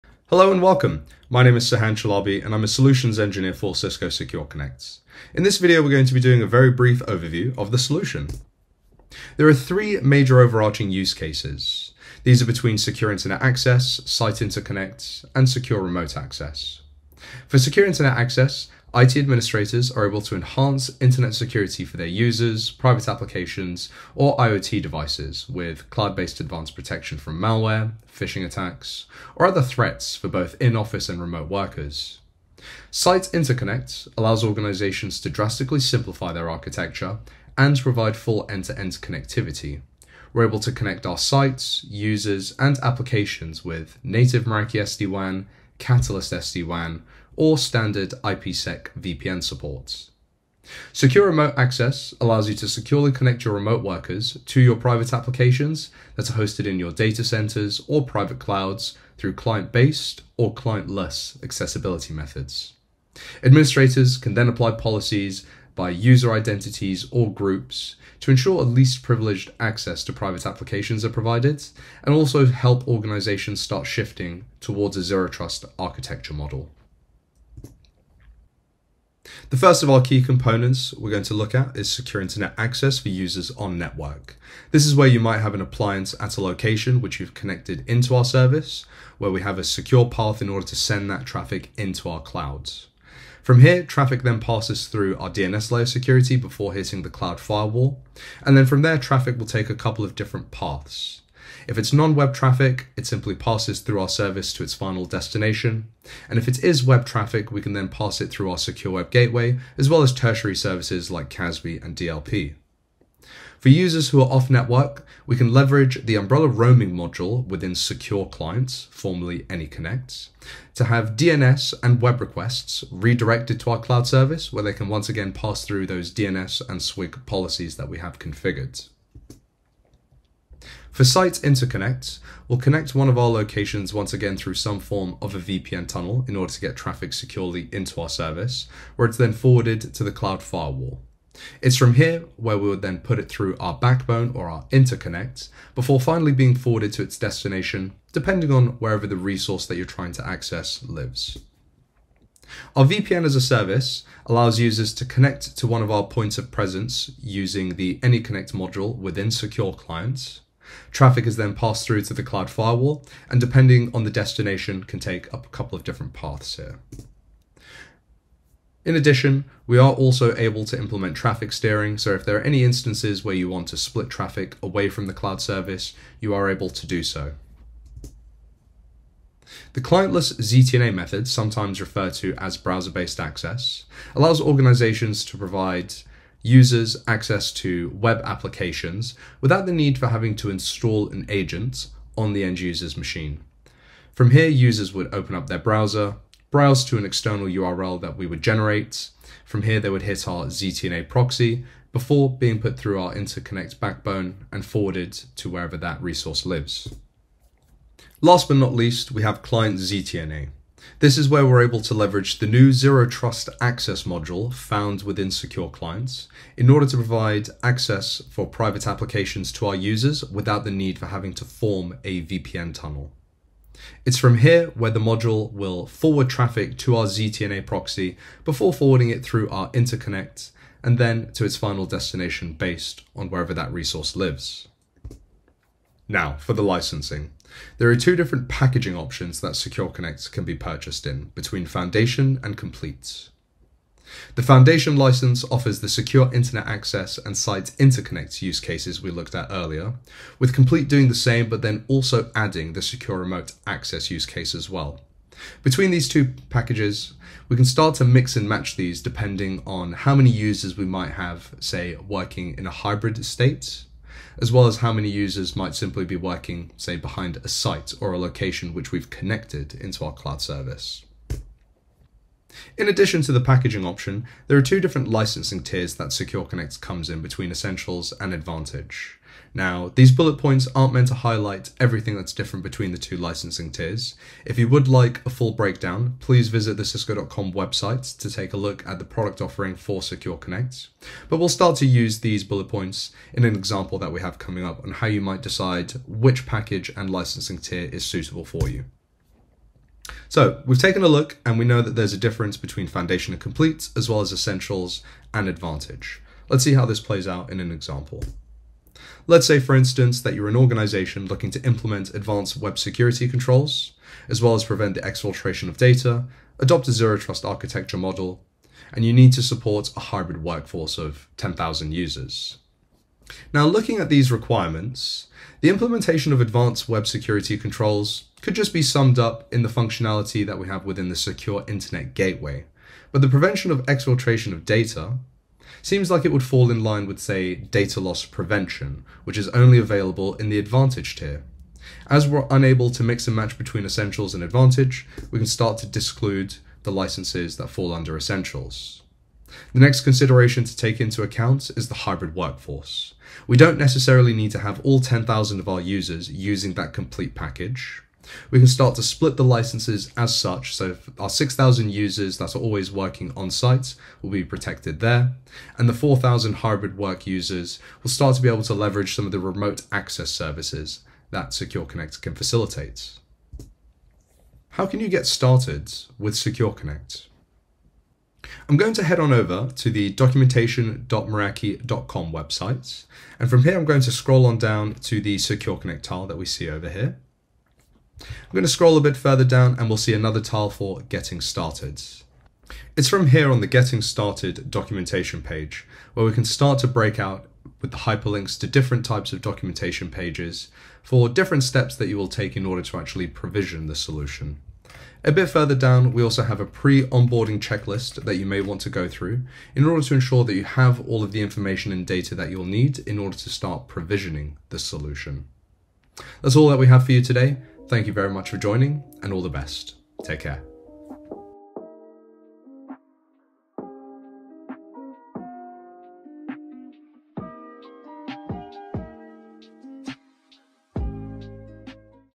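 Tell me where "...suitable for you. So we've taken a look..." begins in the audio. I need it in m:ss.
4:58.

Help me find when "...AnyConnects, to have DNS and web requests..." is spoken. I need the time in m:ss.
1:59.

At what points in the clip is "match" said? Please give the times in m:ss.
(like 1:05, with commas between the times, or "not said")
4:18, 5:43.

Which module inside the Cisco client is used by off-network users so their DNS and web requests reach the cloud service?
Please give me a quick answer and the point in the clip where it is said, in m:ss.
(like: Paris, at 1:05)
Umbrella Roaming module, at 1:56.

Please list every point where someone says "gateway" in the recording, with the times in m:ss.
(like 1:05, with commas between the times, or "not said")
1:49, 5:32.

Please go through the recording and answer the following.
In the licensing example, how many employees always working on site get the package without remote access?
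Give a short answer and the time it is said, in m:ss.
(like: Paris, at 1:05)
6,000, at 6:01.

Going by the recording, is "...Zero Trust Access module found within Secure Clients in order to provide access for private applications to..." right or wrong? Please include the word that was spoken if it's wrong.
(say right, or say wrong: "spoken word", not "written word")
right.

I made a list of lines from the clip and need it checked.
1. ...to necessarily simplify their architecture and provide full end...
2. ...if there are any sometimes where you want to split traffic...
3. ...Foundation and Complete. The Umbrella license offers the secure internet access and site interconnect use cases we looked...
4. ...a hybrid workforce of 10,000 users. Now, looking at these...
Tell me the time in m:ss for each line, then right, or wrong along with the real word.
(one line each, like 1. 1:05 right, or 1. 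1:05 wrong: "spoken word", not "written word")
1. 0:35 wrong: "drastically", not "necessarily"
2. 2:52 wrong: "instances", not "sometimes"
3. 4:01 wrong: "Foundation", not "Umbrella"
4. 5:19 right.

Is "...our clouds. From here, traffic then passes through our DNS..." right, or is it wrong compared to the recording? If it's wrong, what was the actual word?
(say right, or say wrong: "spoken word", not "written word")
right.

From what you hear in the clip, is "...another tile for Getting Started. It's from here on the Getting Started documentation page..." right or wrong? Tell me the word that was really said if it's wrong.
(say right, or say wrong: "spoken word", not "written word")
right.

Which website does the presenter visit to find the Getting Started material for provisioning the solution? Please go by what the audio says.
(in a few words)
documentation.meraki.com.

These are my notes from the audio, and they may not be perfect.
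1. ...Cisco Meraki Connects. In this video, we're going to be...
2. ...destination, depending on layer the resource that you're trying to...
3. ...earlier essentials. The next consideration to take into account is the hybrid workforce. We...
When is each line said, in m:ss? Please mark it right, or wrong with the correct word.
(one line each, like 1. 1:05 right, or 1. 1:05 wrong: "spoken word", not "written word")
1. 0:03 wrong: "Secure", not "Meraki"
2. 2:27 wrong: "wherever", not "layer"
3. 5:47 wrong: "under", not "earlier".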